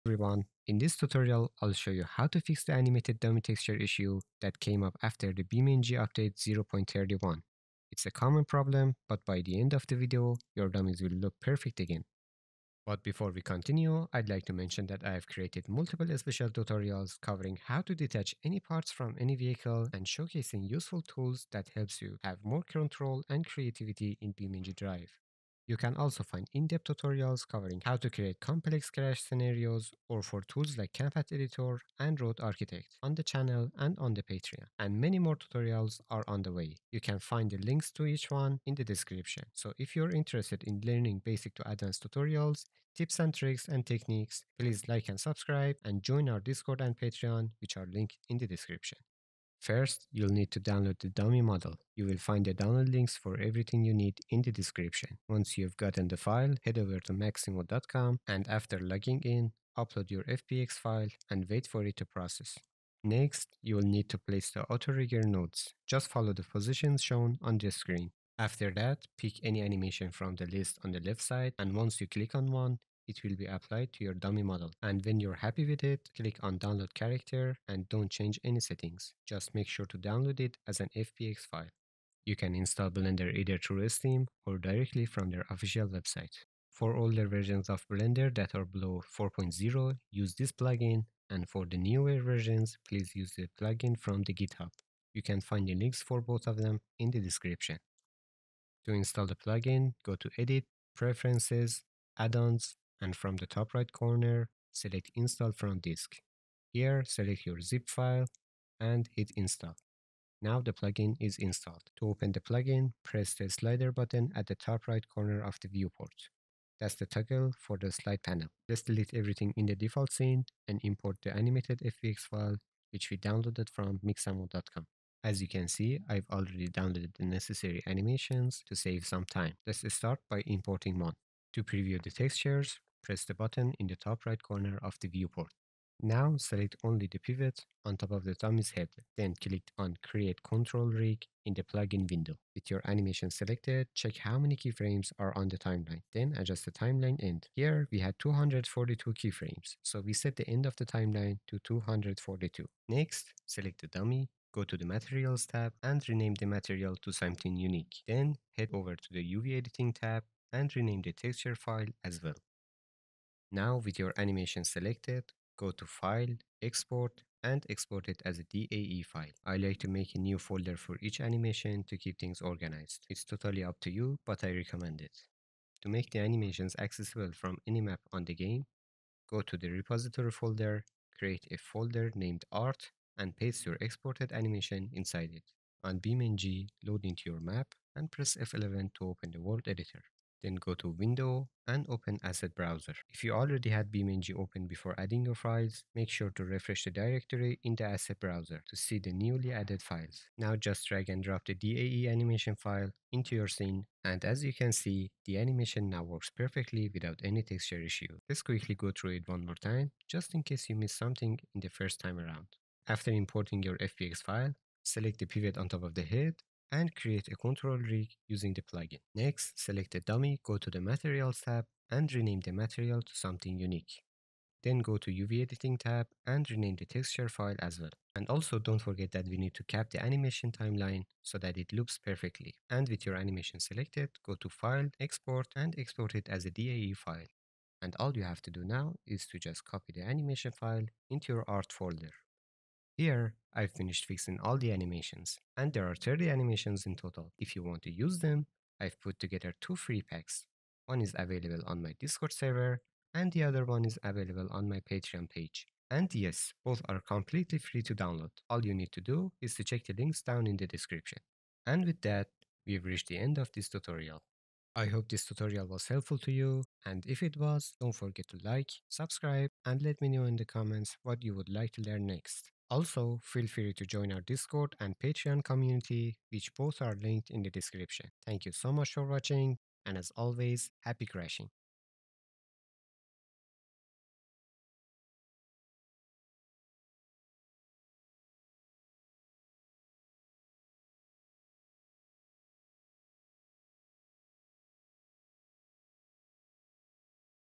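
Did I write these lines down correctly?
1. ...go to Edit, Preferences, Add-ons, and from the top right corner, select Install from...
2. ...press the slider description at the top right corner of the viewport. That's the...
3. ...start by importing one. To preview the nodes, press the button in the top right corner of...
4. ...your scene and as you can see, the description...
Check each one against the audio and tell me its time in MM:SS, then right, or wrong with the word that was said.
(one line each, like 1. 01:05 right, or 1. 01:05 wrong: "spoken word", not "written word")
1. 01:40 right
2. 01:53 wrong: "button", not "description"
3. 02:09 wrong: "textures", not "nodes"
4. 03:23 wrong: "animation", not "description".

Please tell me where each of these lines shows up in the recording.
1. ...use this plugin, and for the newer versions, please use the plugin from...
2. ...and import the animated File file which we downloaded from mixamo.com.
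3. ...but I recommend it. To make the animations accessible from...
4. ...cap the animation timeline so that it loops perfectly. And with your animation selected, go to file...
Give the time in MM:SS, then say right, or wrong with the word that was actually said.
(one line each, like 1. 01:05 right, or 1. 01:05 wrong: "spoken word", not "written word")
1. 01:30 right
2. 02:00 wrong: "FBX", not "File"
3. 02:54 right
4. 03:49 right.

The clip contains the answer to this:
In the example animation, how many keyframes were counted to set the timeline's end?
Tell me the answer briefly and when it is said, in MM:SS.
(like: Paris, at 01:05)
242, at 02:28.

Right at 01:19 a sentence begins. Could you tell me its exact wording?
Just make sure to download it as an FBX file.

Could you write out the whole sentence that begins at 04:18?
All you need to do is to check the links down in the description.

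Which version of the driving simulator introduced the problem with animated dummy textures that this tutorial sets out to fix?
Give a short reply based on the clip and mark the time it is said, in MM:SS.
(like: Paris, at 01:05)
0.31, at 00:06.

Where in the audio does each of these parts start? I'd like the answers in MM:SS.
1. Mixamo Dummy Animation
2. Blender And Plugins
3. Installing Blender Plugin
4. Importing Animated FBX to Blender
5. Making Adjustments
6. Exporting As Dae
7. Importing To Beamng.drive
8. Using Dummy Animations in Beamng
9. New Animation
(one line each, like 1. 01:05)
1. 00:50
2. 01:22
3. 01:38
4. 01:59
5. 02:17
6. 02:44
7. 02:56
8. 03:06
9. 03:28.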